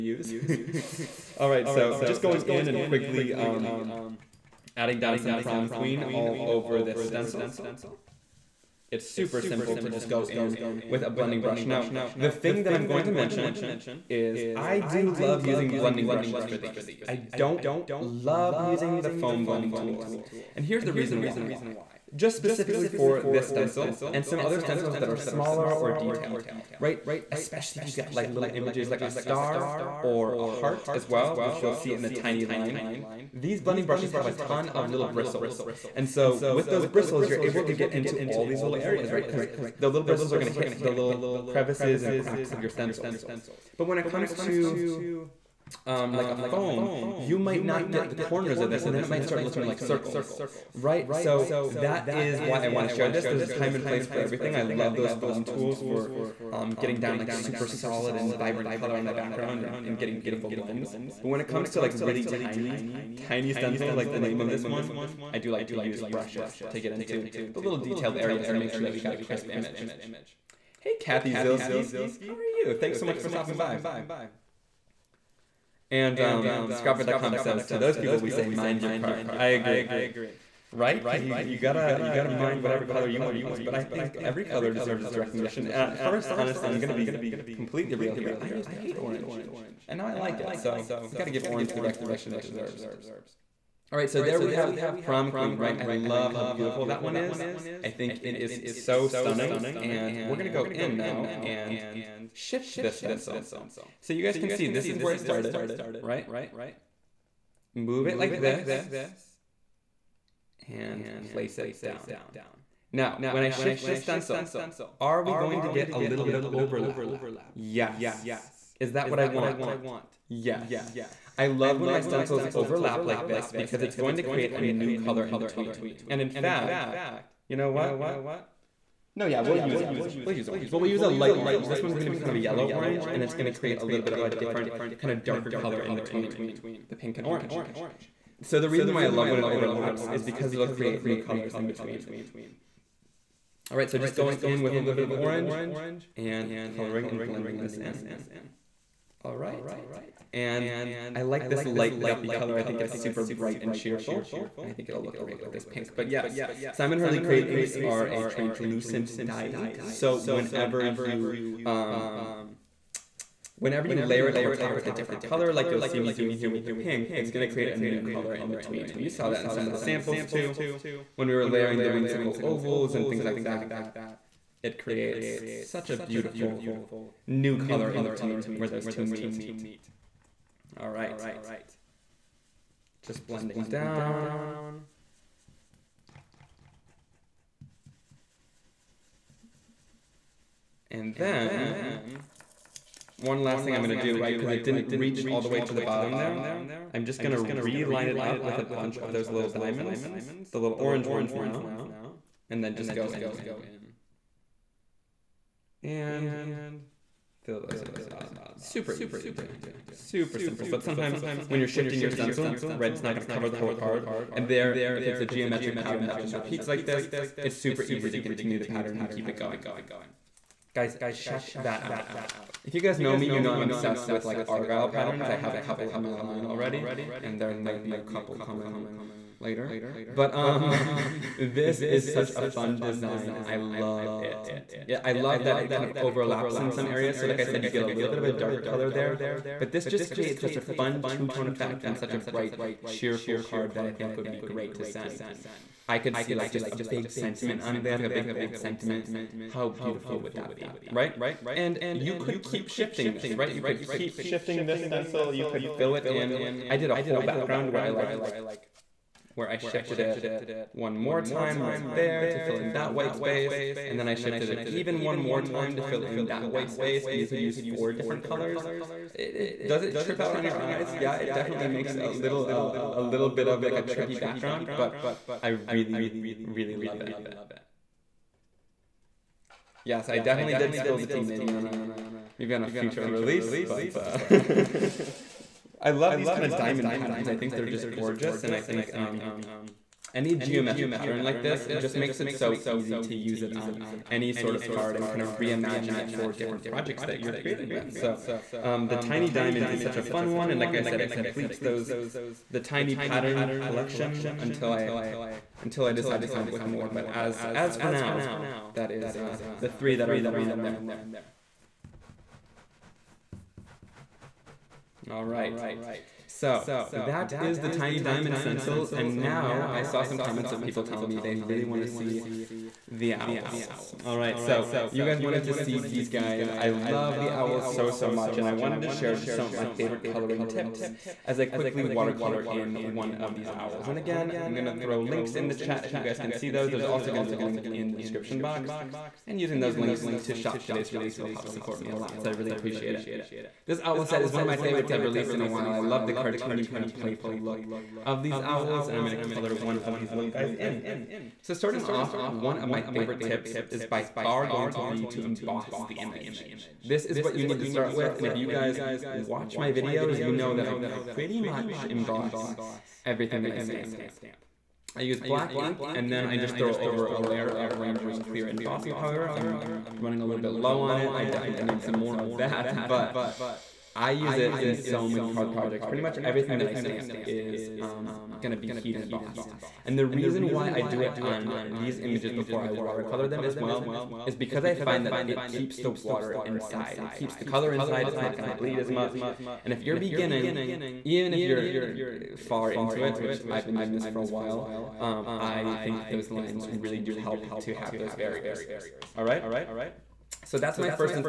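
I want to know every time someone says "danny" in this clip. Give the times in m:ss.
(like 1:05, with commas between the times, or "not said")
not said.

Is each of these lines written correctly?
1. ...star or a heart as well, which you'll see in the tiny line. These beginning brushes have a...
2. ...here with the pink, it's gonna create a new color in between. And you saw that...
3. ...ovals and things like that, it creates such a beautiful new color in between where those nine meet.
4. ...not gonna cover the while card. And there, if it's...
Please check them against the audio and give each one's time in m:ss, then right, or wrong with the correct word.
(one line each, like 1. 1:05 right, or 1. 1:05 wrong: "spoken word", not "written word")
1. 0:29 wrong: "blending", not "beginning"
2. 2:46 right
3. 2:52 wrong: "two", not "nine"
4. 3:33 wrong: "whole", not "while".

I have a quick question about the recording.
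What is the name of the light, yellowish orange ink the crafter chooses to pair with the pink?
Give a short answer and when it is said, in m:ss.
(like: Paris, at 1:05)
light guppy, at 2:31.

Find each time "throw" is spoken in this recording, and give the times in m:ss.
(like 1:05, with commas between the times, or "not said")
5:34, 6:06.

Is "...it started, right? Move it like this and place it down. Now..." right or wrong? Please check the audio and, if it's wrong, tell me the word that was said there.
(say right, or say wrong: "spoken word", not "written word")
right.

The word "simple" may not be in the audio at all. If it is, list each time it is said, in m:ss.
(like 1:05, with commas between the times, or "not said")
0:09, 3:30.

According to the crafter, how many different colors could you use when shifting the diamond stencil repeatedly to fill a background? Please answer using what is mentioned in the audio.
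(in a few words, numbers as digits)
4.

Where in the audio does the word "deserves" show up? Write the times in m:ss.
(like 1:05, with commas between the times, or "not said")
1:24, 1:32.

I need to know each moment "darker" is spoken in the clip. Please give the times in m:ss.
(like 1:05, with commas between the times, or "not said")
2:15, 3:58.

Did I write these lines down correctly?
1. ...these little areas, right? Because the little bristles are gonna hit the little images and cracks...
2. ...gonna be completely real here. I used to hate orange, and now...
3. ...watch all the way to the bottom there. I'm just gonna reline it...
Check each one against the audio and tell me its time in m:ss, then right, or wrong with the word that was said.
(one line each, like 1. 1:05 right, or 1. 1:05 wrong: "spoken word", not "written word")
1. 0:38 wrong: "crevices", not "images"
2. 1:26 right
3. 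3:14 wrong: "reach", not "watch".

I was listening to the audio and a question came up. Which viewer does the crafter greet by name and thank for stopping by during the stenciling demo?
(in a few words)
Kathy Zilski.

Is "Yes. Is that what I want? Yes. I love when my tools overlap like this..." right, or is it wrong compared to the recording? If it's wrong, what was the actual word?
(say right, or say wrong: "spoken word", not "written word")
wrong: "stencils", not "tools".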